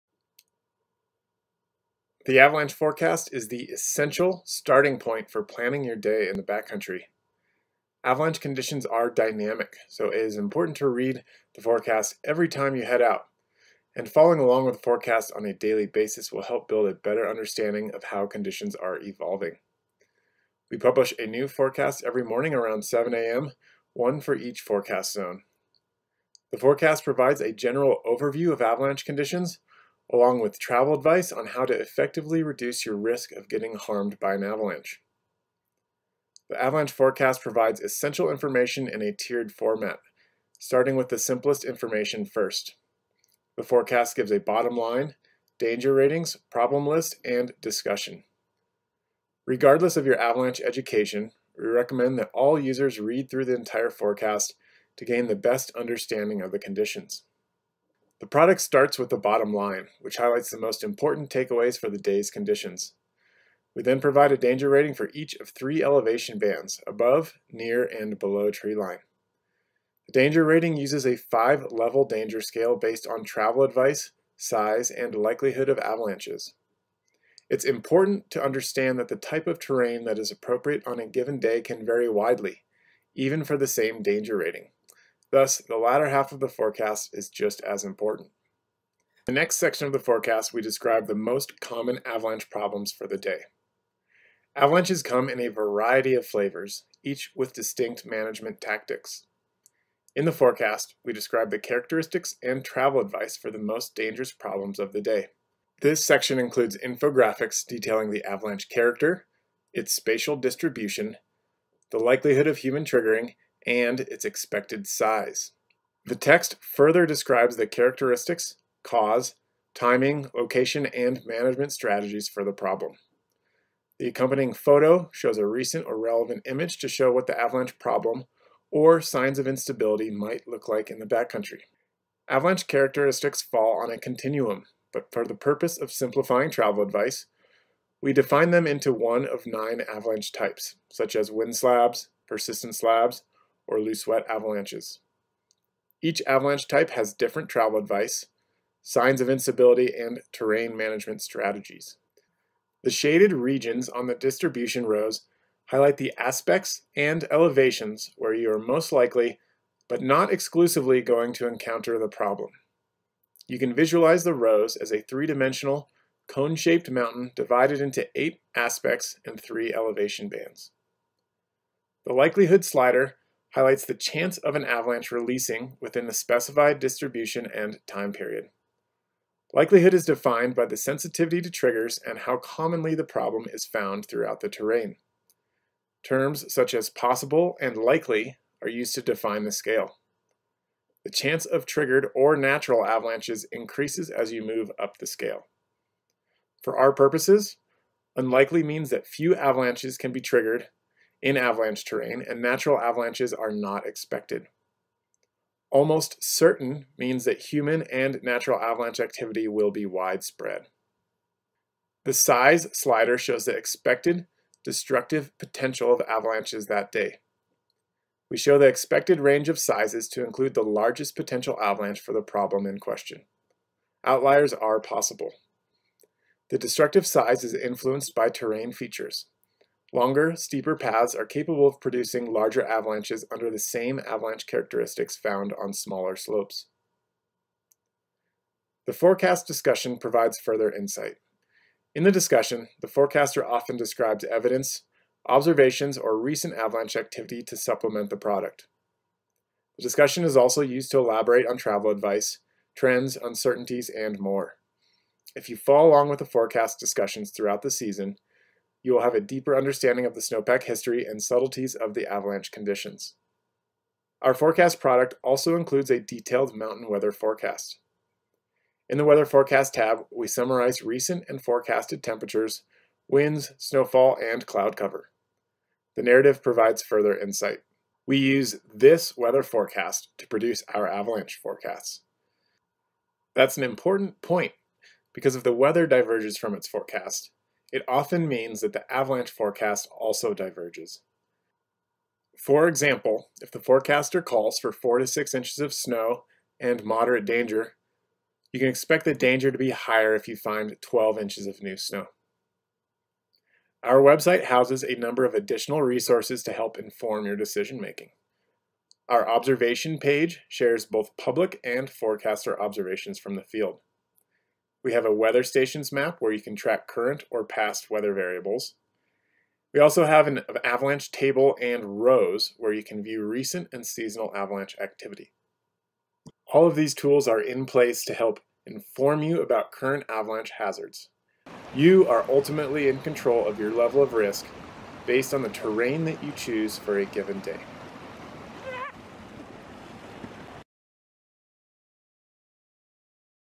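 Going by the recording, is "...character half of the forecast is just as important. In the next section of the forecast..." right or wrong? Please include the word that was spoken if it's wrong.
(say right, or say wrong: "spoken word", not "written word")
wrong: "latter", not "character".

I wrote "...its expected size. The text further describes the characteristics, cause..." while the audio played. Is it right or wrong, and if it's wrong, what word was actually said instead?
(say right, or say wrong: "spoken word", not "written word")
right.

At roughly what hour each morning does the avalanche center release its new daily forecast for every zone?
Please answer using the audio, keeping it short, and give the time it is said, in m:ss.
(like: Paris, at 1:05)
7 a.m., at 0:22.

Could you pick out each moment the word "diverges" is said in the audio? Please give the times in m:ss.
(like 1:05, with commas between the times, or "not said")
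4:45, 4:50.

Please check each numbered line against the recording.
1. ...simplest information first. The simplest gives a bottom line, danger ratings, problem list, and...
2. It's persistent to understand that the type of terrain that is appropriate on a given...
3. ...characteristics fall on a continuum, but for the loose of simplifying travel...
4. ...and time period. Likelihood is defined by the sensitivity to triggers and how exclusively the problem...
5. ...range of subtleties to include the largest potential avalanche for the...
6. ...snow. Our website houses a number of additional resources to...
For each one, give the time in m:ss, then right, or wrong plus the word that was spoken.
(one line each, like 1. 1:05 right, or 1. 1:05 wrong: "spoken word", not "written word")
1. 0:41 wrong: "forecast", not "simplest"
2. 1:17 wrong: "important", not "persistent"
3. 2:12 wrong: "purpose", not "loose"
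4. 2:57 wrong: "commonly", not "exclusively"
5. 3:39 wrong: "sizes", not "subtleties"
6. 5:01 right.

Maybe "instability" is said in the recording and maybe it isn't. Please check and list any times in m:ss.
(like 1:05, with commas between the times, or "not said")
2:09, 2:29.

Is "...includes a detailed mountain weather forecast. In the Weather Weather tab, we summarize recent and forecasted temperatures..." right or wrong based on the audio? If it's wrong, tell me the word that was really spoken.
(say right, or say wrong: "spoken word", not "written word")
wrong: "Forecast", not "Weather".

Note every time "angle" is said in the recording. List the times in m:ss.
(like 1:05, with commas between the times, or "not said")
not said.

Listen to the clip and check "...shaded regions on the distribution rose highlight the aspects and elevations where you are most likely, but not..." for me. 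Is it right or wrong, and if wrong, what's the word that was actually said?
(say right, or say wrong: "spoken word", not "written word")
right.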